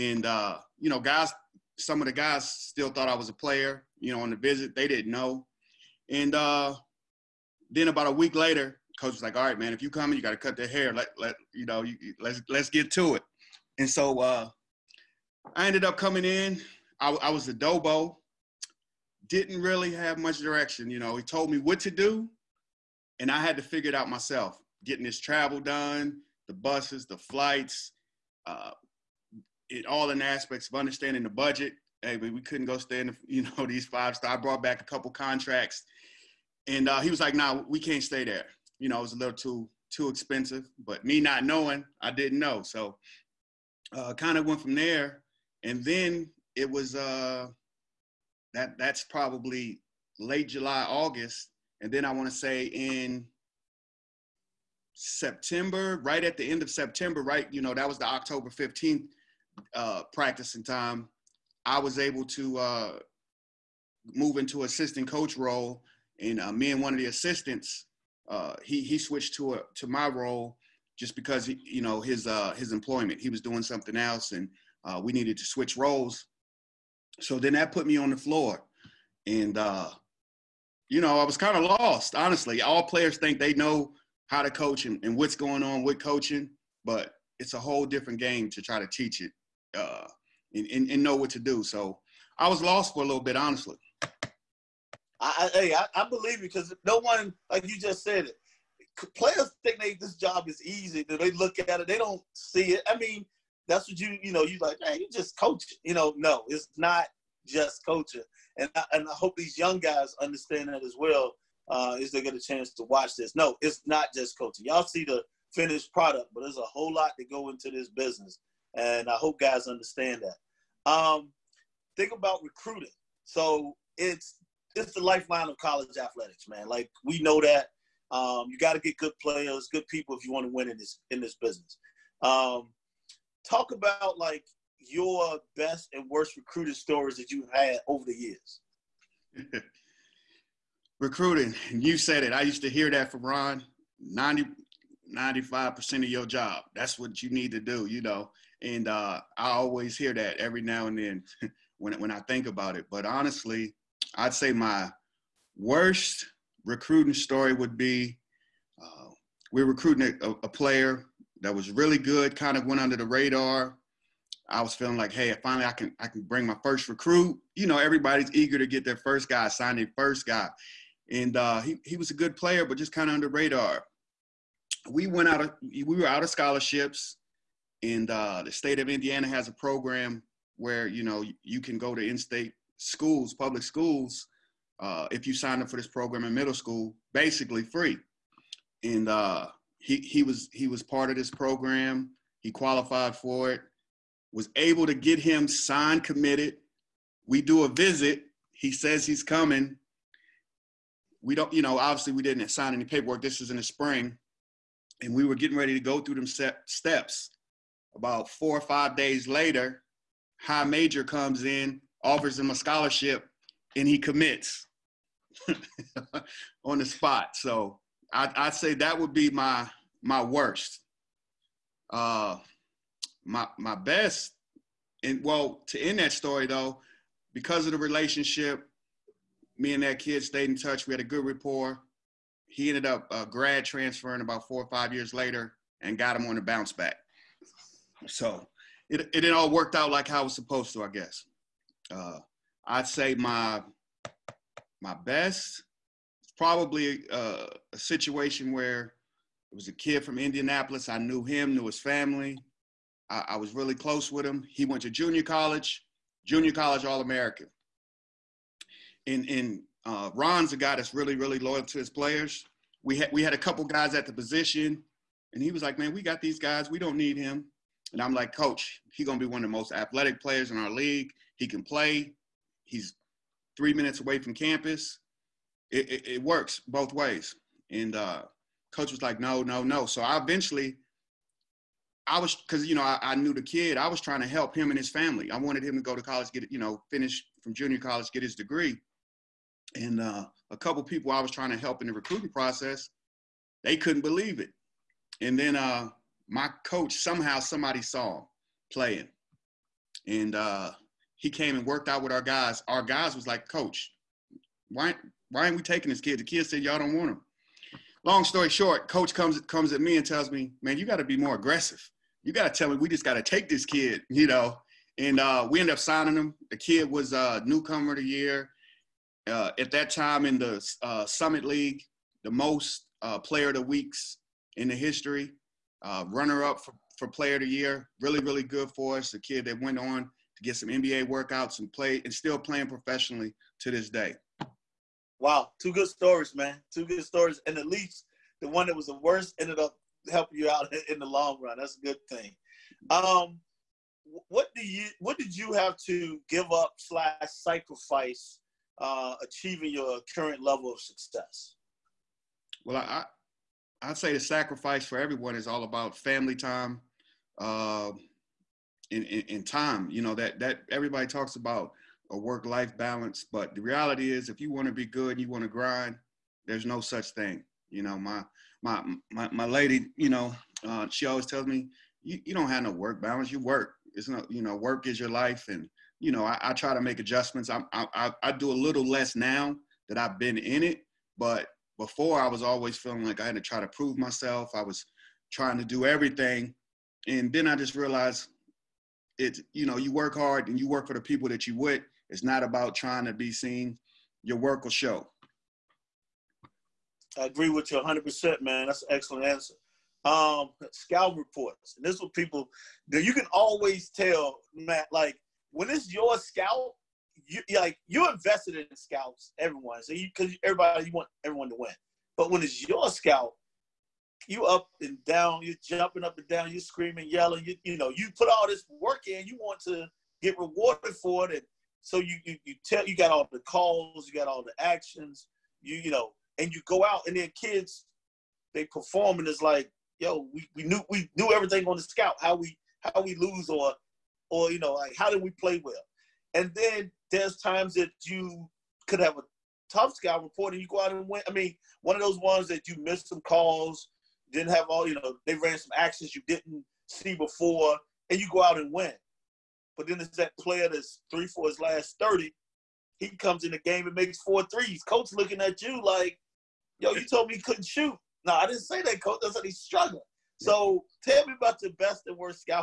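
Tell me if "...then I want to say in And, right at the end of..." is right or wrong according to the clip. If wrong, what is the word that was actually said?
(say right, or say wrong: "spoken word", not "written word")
wrong: "September", not "And".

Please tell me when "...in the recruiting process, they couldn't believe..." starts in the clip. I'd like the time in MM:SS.
04:51.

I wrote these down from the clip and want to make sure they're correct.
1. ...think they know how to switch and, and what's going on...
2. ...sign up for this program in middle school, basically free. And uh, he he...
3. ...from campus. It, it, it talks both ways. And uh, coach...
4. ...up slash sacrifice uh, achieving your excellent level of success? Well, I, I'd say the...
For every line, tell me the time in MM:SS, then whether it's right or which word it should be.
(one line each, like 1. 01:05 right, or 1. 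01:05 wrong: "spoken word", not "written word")
1. 01:23 wrong: "coach", not "switch"
2. 03:05 right
3. 04:34 wrong: "works", not "talks"
4. 05:46 wrong: "current", not "excellent".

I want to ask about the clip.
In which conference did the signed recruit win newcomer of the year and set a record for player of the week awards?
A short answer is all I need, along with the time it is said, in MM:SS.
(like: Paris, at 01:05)
Summit League, at 05:21.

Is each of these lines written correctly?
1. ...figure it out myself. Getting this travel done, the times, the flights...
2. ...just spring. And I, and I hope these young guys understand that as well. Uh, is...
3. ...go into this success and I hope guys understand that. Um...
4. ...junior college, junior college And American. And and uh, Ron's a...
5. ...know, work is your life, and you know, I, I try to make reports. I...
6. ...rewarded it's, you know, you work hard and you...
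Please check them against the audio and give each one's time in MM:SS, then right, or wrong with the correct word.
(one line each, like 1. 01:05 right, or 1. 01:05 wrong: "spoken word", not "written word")
1. 00:23 wrong: "buses", not "times"
2. 01:47 wrong: "coaching", not "spring"
3. 01:57 wrong: "business", not "success"
4. 04:14 wrong: "All", not "And"
5. 06:14 wrong: "adjustments", not "reports"
6. 06:27 wrong: "realized", not "rewarded".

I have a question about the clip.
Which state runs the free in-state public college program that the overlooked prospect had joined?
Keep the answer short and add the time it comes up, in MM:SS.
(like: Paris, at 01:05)
Indiana, at 02:58.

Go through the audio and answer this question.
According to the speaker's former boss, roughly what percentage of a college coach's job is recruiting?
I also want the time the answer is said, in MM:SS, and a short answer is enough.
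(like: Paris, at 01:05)
95%, at 02:25.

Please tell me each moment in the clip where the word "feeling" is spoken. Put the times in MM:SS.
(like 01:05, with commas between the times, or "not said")
02:44, 06:22.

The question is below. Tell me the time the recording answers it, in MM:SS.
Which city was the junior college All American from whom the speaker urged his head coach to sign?
04:10.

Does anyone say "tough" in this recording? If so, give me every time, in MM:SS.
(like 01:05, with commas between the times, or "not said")
07:19.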